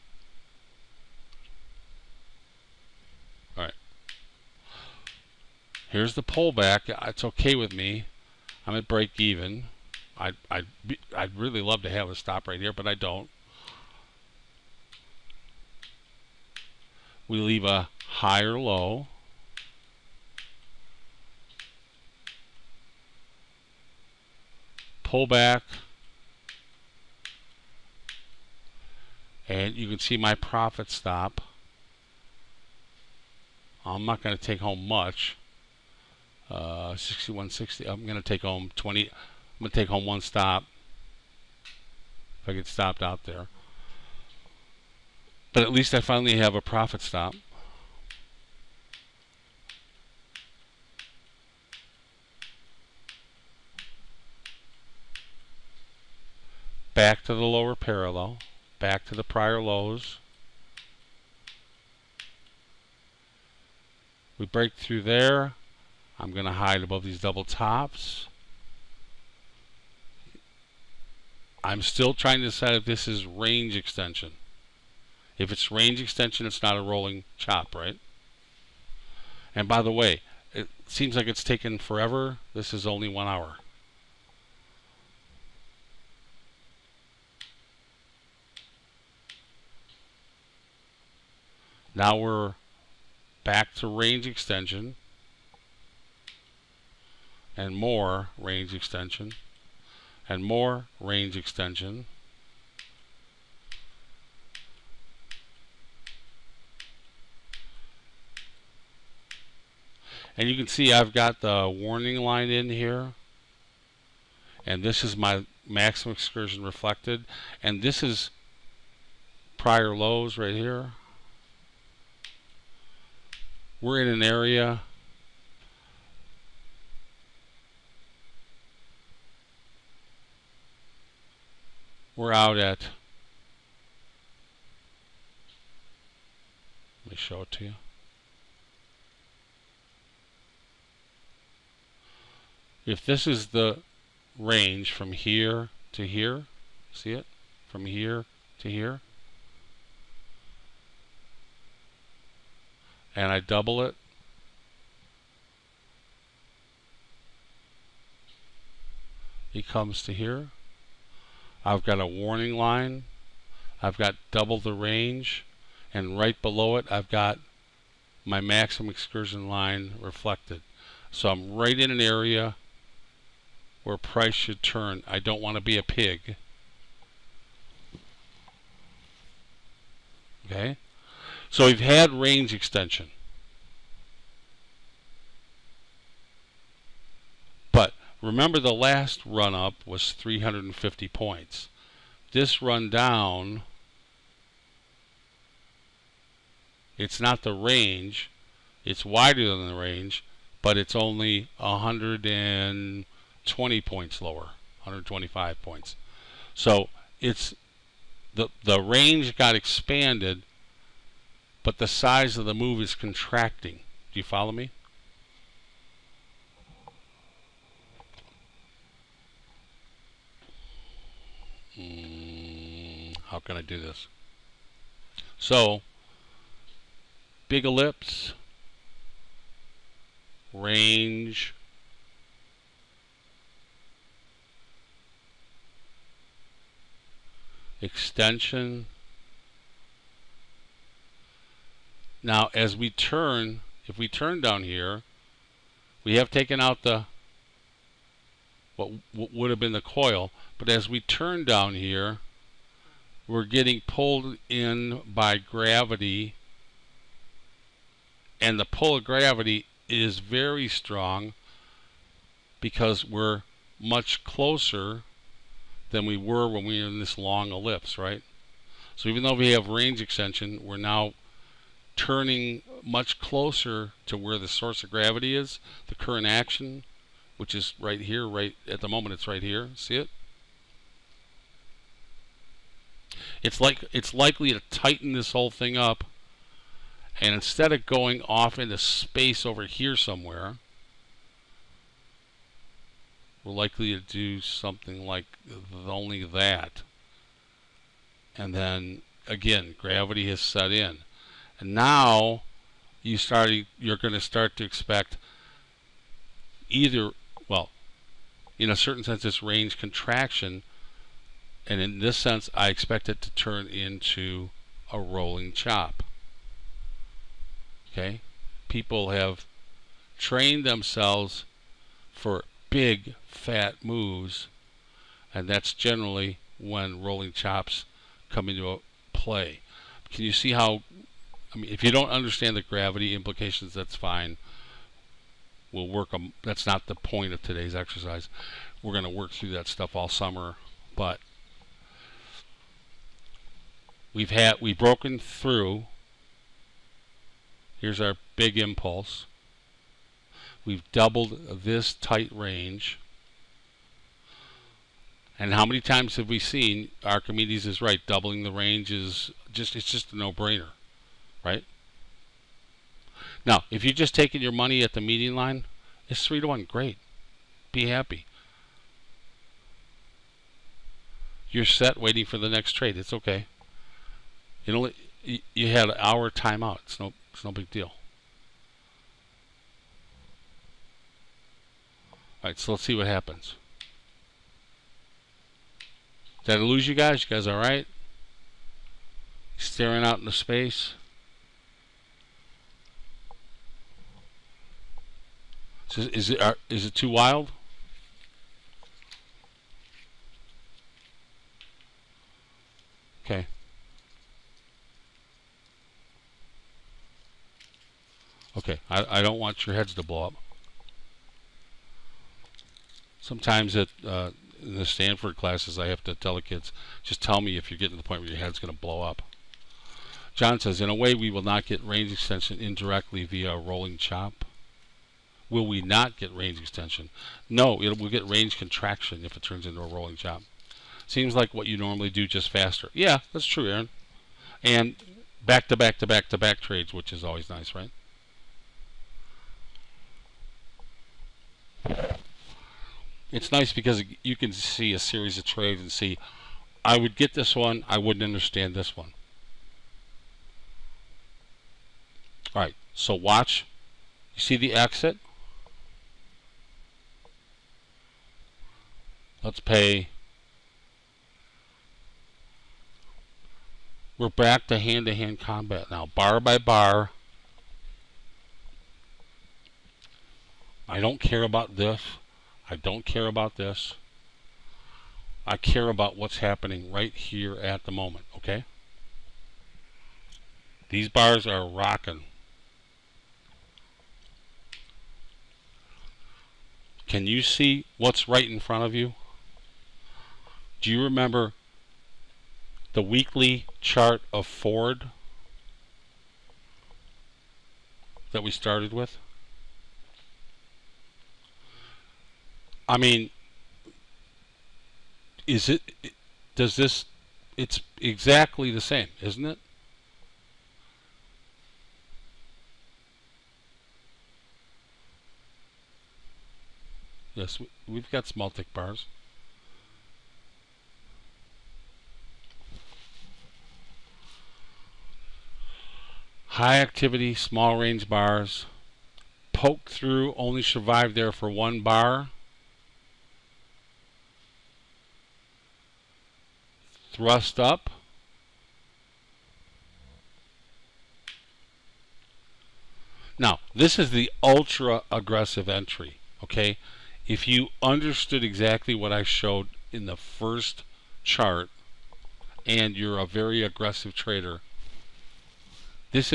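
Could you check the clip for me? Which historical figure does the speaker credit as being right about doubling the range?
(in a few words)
Archimedes.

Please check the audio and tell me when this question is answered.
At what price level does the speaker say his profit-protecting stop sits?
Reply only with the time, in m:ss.
0:36.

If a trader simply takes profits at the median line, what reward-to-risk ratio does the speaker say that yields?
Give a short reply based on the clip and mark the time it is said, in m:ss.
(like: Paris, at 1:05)
Three to one, at 6:06.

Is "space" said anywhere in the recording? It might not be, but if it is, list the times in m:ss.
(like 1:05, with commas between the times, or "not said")
4:48, 6:30.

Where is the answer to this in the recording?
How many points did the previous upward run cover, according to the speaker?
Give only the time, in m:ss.
3:10.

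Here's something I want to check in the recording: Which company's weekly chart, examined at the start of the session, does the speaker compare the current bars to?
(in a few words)
Ford.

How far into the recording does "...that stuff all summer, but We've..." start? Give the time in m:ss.
5:39.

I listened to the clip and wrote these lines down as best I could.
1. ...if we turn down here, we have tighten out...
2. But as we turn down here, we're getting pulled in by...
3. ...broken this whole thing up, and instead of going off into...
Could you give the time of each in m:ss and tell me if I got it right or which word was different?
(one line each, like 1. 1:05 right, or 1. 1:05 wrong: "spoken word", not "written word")
1. 4:03 wrong: "taken", not "tighten"
2. 4:10 right
3. 4:44 wrong: "tighten", not "broken".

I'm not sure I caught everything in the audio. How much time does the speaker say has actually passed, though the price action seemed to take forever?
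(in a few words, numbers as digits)
One hour.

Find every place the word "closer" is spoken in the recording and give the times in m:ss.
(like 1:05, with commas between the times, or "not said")
4:24, 4:33.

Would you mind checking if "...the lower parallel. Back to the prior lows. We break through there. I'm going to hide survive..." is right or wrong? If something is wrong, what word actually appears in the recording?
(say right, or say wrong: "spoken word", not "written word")
wrong: "above", not "survive".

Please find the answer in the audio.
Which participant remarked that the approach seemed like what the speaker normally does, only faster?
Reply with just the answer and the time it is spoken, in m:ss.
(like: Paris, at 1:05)
Aaron, at 7:13.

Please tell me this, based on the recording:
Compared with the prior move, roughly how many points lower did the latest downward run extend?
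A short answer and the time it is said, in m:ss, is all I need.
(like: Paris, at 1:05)
125 points, at 3:24.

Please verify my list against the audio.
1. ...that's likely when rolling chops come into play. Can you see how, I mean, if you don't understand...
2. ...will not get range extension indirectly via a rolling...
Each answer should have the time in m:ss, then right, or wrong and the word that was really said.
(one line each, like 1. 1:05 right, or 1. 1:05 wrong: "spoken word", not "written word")
1. 5:25 wrong: "generally", not "likely"
2. 7:01 right.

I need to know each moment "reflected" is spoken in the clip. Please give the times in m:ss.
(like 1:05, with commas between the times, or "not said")
1:56, 2:49.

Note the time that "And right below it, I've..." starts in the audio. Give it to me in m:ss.
2:45.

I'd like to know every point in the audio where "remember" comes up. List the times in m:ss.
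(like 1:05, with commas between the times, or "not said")
3:08, 8:11.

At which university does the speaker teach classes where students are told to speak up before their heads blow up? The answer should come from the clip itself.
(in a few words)
Stanford.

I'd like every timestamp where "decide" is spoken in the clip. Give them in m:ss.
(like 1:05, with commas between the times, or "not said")
1:12.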